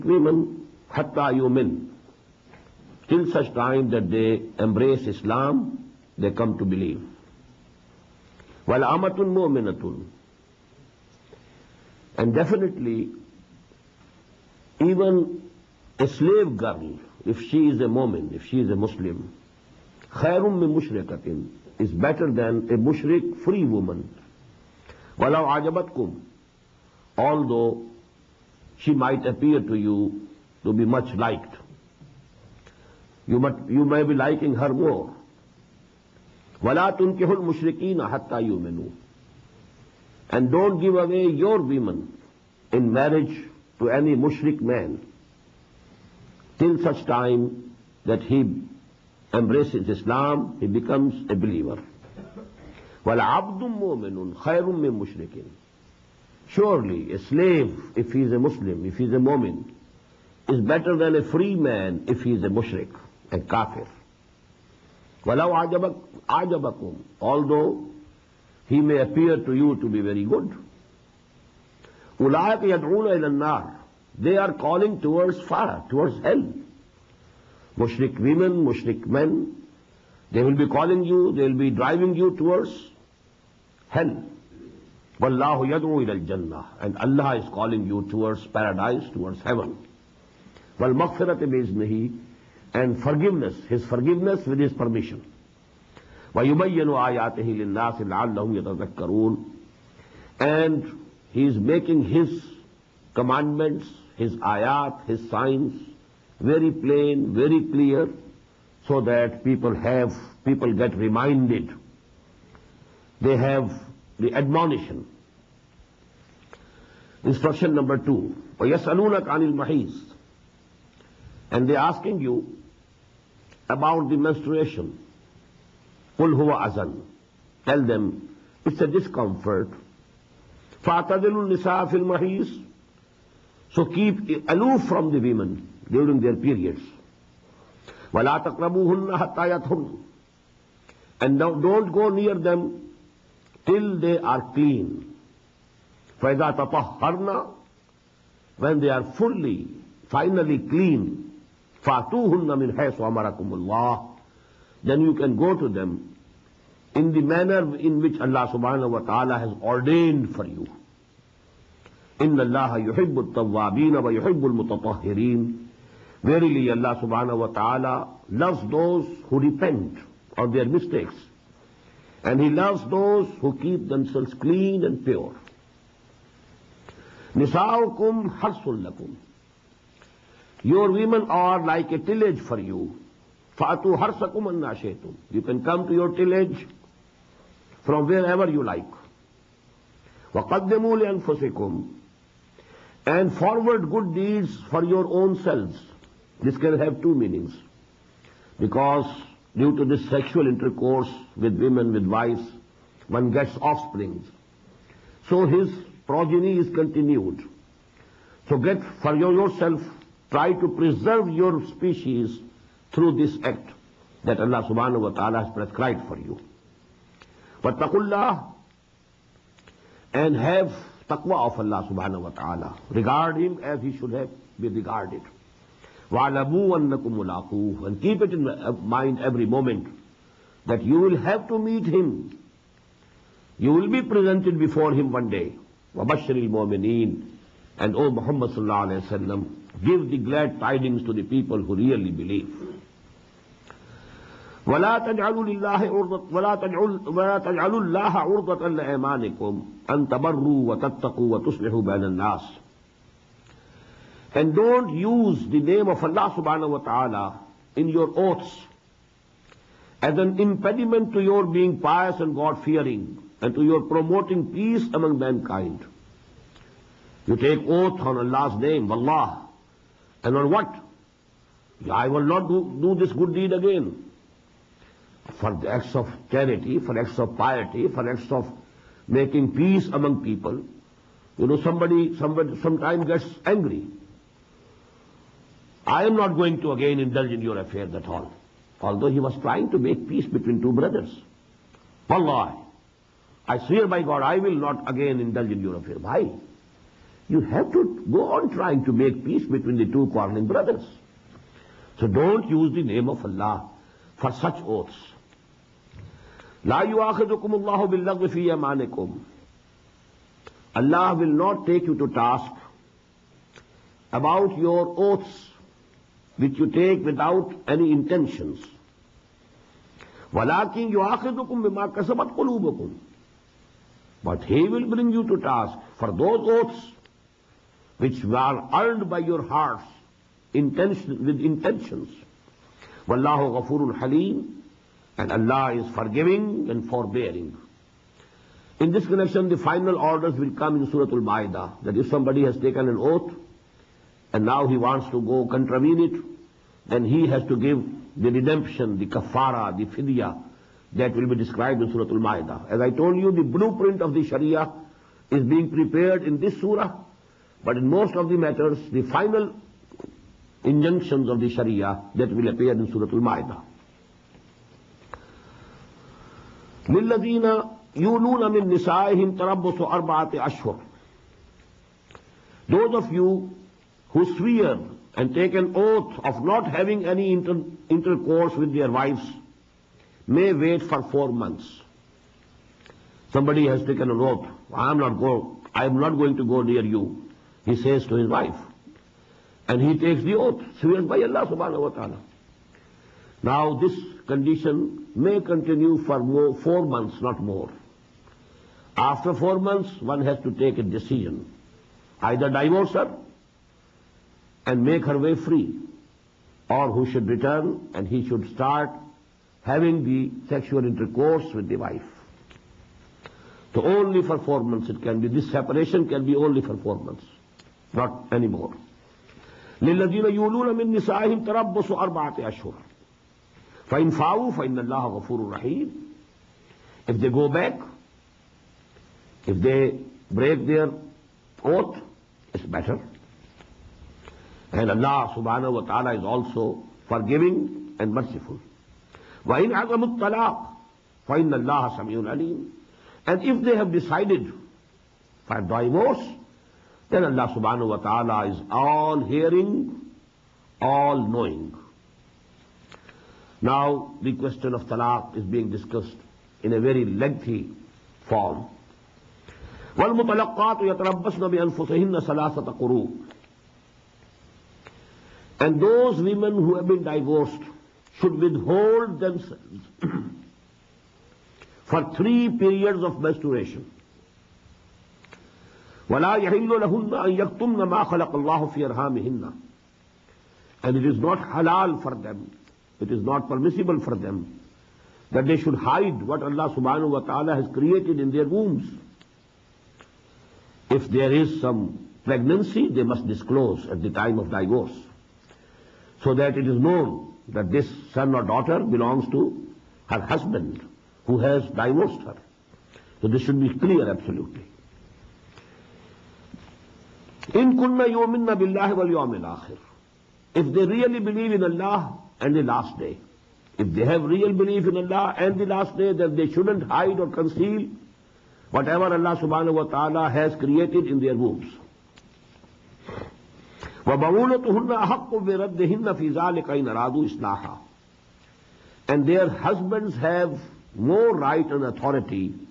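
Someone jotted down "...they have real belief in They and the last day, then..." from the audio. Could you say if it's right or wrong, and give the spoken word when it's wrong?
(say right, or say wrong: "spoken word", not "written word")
wrong: "Allah", not "They".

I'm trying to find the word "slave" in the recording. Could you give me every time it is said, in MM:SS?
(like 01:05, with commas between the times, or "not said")
00:16, 00:57.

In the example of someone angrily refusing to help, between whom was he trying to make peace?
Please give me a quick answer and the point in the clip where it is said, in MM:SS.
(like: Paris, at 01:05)
two brothers, at 04:50.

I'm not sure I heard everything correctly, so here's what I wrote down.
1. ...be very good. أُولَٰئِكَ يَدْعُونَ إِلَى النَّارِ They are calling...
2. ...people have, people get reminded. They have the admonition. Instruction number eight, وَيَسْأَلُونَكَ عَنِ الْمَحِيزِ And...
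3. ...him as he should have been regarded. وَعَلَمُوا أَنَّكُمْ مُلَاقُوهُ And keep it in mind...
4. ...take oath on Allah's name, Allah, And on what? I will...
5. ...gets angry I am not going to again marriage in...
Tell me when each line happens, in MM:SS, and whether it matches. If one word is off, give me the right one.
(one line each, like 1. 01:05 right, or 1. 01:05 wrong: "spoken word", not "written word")
1. 01:09 right
2. 01:49 wrong: "two", not "eight"
3. 03:43 right
4. 04:27 right
5. 04:43 wrong: "indulge", not "marriage".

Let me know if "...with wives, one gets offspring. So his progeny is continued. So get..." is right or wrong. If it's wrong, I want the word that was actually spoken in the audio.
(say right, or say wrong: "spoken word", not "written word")
right.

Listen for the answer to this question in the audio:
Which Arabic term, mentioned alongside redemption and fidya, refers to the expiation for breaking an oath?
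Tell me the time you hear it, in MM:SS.
05:48.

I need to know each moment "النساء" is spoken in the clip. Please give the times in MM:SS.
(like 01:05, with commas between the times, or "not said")
02:11.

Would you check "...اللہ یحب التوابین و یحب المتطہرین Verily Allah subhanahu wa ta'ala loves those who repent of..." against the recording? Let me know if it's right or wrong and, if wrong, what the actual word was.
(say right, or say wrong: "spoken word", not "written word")
right.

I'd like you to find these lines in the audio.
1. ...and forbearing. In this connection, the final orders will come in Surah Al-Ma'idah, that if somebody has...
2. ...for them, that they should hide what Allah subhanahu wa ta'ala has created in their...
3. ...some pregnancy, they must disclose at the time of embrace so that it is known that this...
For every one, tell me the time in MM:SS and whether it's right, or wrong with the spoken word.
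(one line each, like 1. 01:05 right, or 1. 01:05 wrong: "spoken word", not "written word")
1. 05:36 right
2. 08:03 right
3. 08:11 wrong: "divorce", not "embrace".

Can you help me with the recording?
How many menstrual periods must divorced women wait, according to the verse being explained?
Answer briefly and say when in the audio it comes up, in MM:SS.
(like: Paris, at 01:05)
3, at 07:52.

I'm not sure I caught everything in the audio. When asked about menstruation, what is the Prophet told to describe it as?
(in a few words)
a discomfort.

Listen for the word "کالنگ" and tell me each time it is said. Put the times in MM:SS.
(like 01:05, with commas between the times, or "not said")
01:20, 01:27.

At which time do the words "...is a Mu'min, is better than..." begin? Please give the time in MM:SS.
00:59.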